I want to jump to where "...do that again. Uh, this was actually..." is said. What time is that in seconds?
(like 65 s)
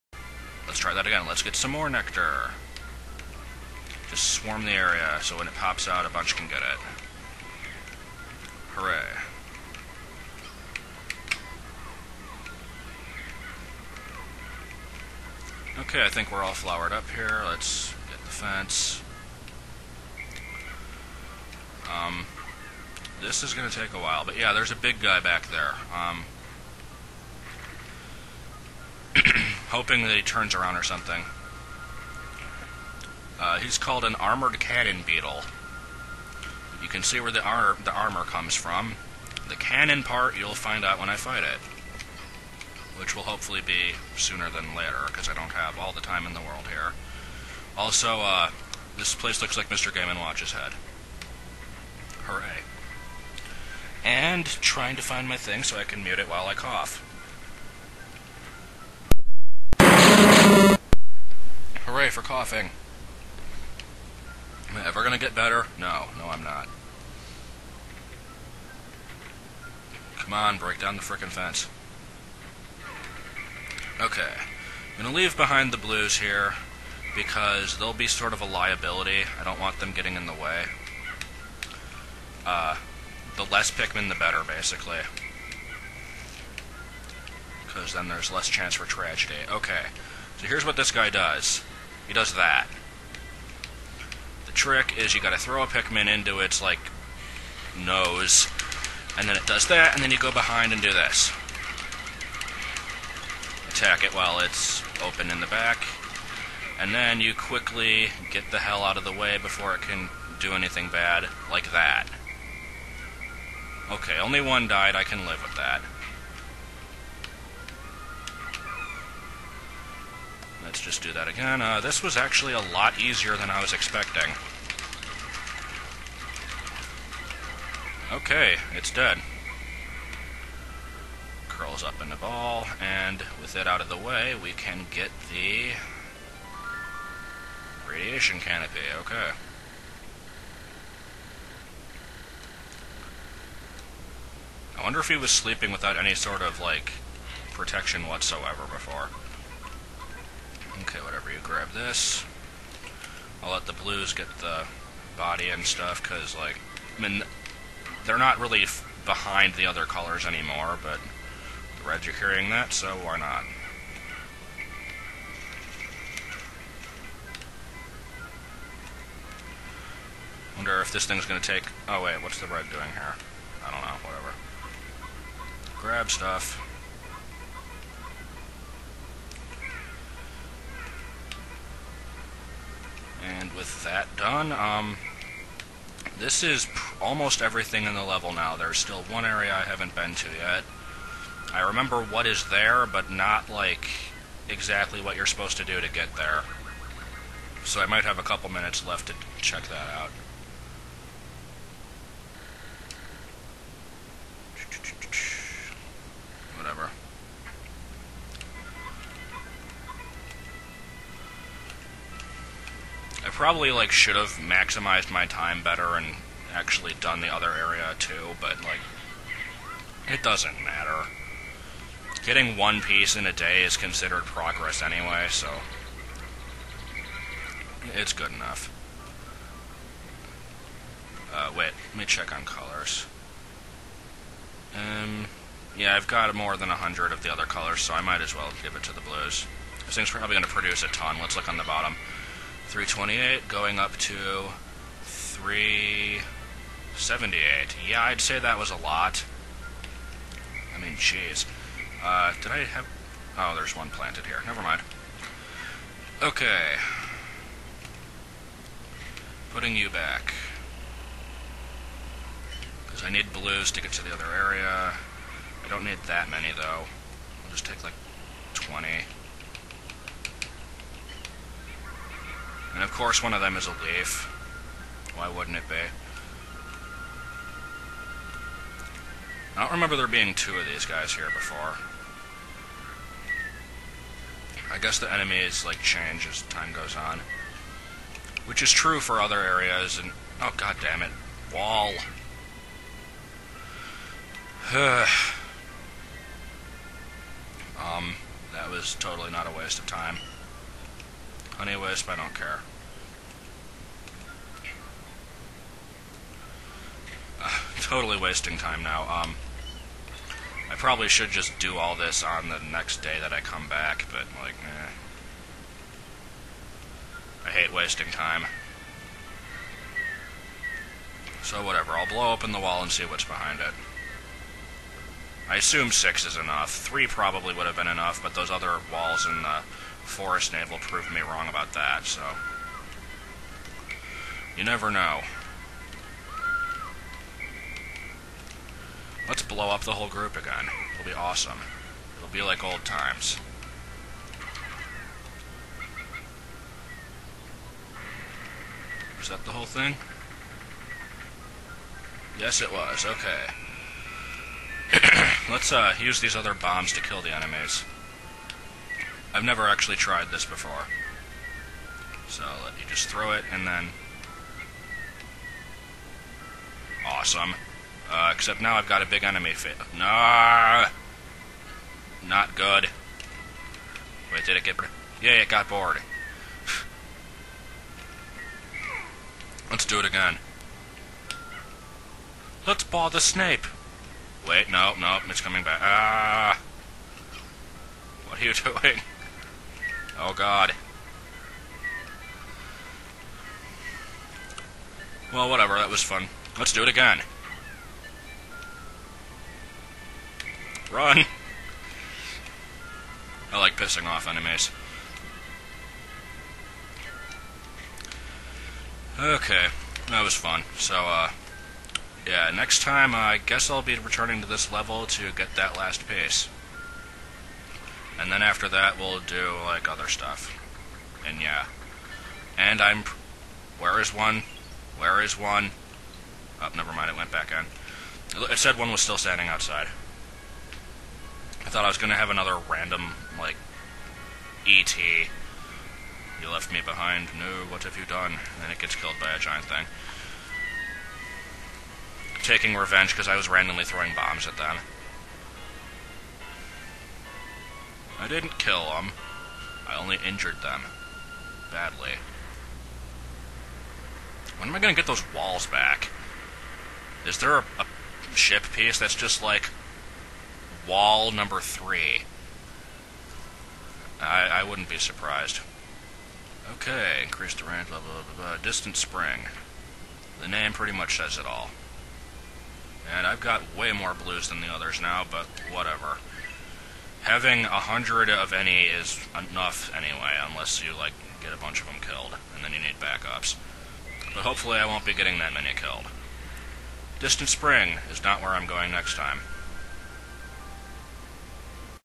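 121 s.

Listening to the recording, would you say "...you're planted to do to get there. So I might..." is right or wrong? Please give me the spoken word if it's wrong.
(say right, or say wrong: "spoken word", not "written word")
wrong: "supposed", not "planted".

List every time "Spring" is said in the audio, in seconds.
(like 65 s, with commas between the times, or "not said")
468 s, 487 s.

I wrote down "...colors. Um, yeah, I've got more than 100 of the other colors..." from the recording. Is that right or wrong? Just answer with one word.
right.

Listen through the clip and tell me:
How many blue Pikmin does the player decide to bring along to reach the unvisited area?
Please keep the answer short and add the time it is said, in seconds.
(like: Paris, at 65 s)
20, at 268 s.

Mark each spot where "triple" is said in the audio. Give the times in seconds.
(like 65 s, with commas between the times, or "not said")
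not said.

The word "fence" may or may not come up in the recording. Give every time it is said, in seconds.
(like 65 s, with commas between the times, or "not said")
18 s, 71 s.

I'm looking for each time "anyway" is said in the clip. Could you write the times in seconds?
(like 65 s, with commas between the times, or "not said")
224 s, 301 s, 479 s.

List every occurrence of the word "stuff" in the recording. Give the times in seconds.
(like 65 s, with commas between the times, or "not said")
155 s, 176 s, 420 s.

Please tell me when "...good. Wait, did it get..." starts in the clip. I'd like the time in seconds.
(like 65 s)
372 s.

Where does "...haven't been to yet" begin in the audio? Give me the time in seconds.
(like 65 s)
189 s.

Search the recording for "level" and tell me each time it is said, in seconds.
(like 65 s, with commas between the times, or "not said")
188 s, 414 s.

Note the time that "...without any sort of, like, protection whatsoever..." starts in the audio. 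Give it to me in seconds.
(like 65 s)
145 s.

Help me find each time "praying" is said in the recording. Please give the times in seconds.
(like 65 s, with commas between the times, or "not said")
not said.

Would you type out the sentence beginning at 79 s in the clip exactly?
I don't want them getting in the way.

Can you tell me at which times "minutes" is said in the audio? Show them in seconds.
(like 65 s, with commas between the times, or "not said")
198 s.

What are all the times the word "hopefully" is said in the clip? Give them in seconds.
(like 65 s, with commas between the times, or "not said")
43 s, 484 s.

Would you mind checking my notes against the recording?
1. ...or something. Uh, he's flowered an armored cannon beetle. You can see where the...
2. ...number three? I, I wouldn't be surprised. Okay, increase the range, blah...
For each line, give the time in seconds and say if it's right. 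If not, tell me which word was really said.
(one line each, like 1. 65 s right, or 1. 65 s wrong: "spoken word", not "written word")
1. 30 s wrong: "called", not "flowered"
2. 461 s right.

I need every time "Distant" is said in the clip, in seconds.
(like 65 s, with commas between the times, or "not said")
468 s, 487 s.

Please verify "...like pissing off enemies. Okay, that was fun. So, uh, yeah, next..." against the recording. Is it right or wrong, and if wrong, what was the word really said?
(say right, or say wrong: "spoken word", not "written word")
right.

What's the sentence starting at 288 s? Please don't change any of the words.
Which is true for other areas and oh god damn it.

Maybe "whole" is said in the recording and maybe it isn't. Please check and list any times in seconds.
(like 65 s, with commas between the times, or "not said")
339 s, 349 s.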